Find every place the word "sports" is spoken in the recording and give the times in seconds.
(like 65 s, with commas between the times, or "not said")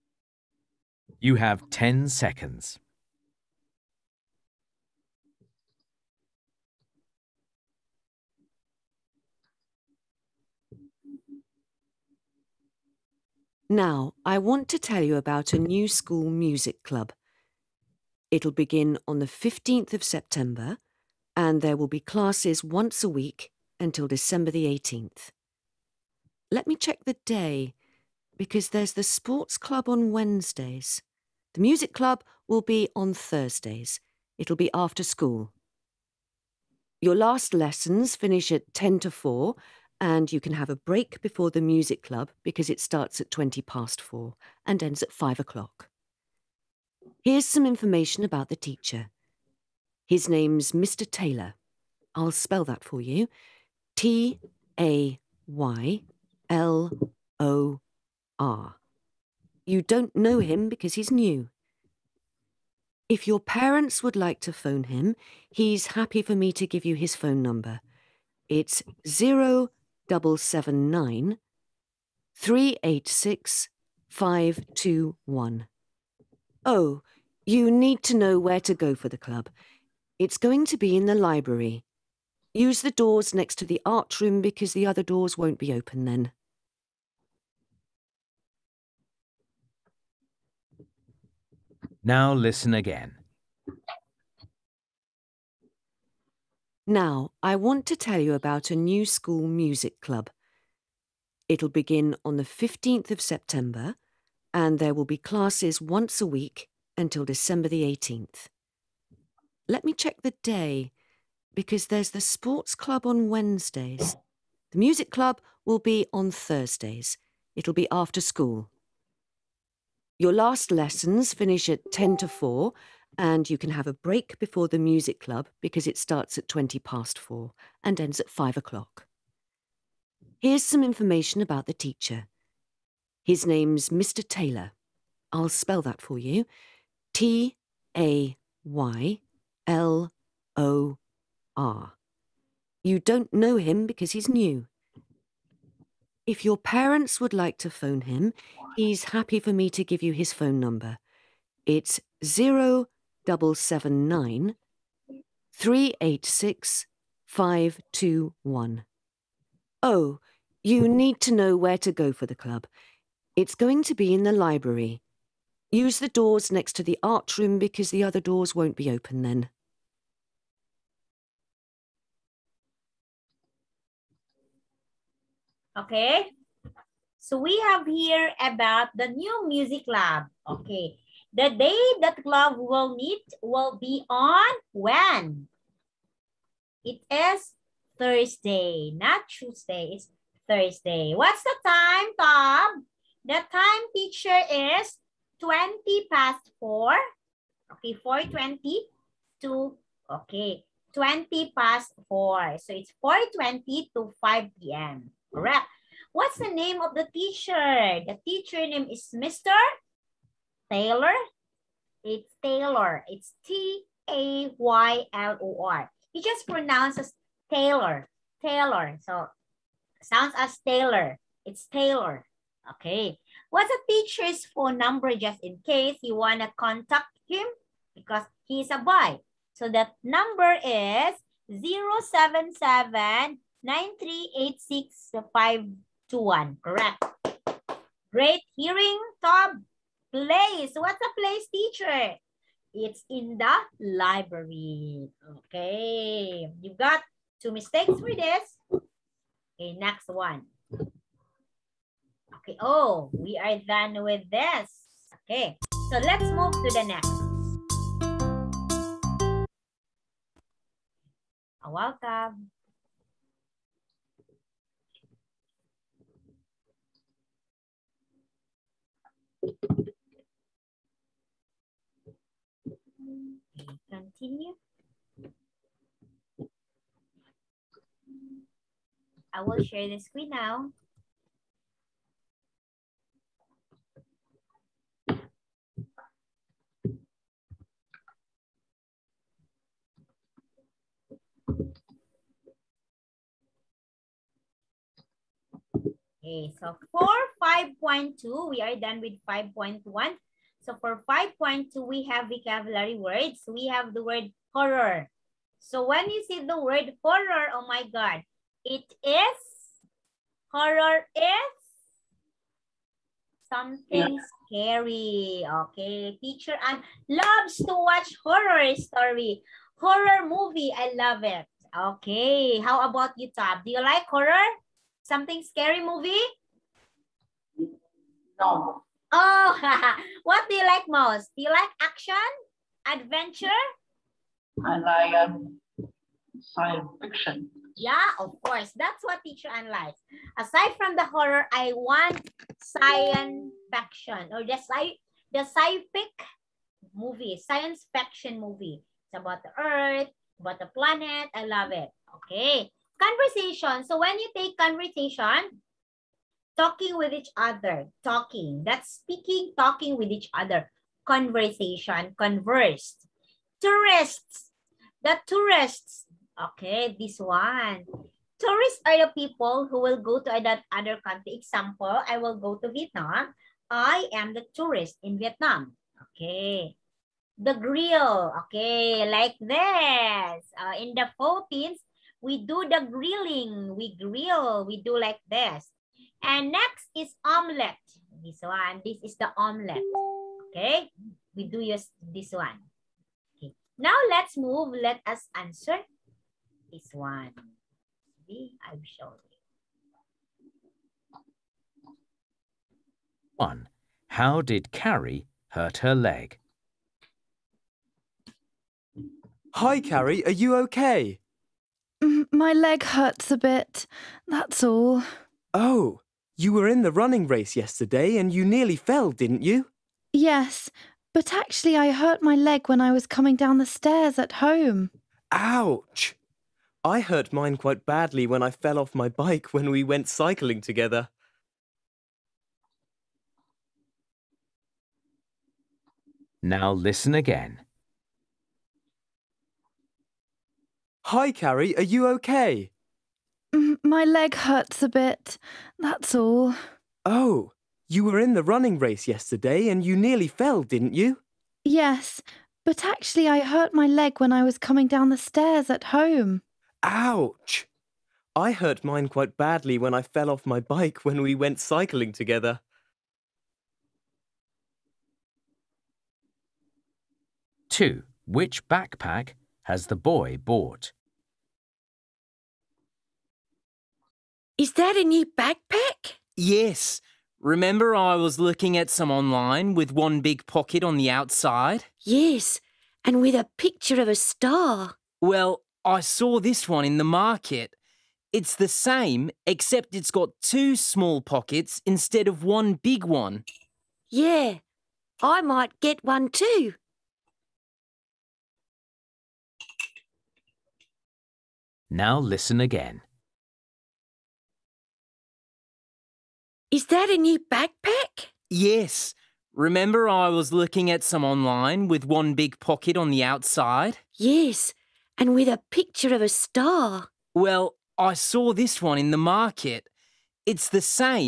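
29 s, 112 s.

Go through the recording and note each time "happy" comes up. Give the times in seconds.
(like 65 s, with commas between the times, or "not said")
65 s, 149 s.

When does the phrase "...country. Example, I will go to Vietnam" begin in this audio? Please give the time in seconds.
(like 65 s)
371 s.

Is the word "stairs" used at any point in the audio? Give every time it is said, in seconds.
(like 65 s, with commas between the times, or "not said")
423 s, 455 s.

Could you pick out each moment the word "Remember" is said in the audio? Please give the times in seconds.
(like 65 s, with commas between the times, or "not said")
477 s, 509 s.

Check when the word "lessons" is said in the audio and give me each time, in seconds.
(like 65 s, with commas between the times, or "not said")
37 s, 120 s.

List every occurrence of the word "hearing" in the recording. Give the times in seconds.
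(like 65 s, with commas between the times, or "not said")
238 s.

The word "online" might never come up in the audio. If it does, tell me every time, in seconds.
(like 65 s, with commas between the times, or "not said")
479 s, 511 s.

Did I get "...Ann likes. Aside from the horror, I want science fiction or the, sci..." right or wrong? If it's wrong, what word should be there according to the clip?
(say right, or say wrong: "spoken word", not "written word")
right.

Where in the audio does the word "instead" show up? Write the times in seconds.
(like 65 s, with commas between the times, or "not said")
491 s.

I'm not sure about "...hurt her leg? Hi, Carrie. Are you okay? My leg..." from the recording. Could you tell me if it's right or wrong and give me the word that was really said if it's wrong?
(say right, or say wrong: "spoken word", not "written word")
right.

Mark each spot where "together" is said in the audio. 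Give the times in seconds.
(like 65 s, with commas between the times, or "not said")
430 s, 462 s.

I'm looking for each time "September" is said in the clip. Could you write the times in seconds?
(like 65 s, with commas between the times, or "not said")
20 s, 103 s.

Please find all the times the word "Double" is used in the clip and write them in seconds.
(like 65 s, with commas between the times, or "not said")
70 s, 153 s.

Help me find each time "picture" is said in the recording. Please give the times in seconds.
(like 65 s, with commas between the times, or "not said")
483 s, 515 s.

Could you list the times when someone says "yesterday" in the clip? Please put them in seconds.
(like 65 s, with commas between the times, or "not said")
417 s, 449 s.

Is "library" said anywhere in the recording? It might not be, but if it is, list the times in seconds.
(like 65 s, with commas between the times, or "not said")
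81 s, 164 s, 243 s.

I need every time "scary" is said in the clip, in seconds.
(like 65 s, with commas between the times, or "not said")
314 s, 325 s.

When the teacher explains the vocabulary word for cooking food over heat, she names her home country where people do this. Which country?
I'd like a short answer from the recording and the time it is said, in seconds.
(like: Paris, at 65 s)
Philippines, at 381 s.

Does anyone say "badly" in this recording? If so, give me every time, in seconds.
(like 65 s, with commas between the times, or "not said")
427 s, 459 s.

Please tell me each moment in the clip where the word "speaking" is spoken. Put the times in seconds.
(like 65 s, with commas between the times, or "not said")
359 s.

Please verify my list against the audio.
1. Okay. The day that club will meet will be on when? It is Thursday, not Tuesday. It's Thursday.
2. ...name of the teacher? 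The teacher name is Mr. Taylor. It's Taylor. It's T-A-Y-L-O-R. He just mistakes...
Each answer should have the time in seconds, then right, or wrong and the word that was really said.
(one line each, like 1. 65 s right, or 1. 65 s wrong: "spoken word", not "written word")
1. 180 s right
2. 206 s wrong: "pronounces", not "mistakes".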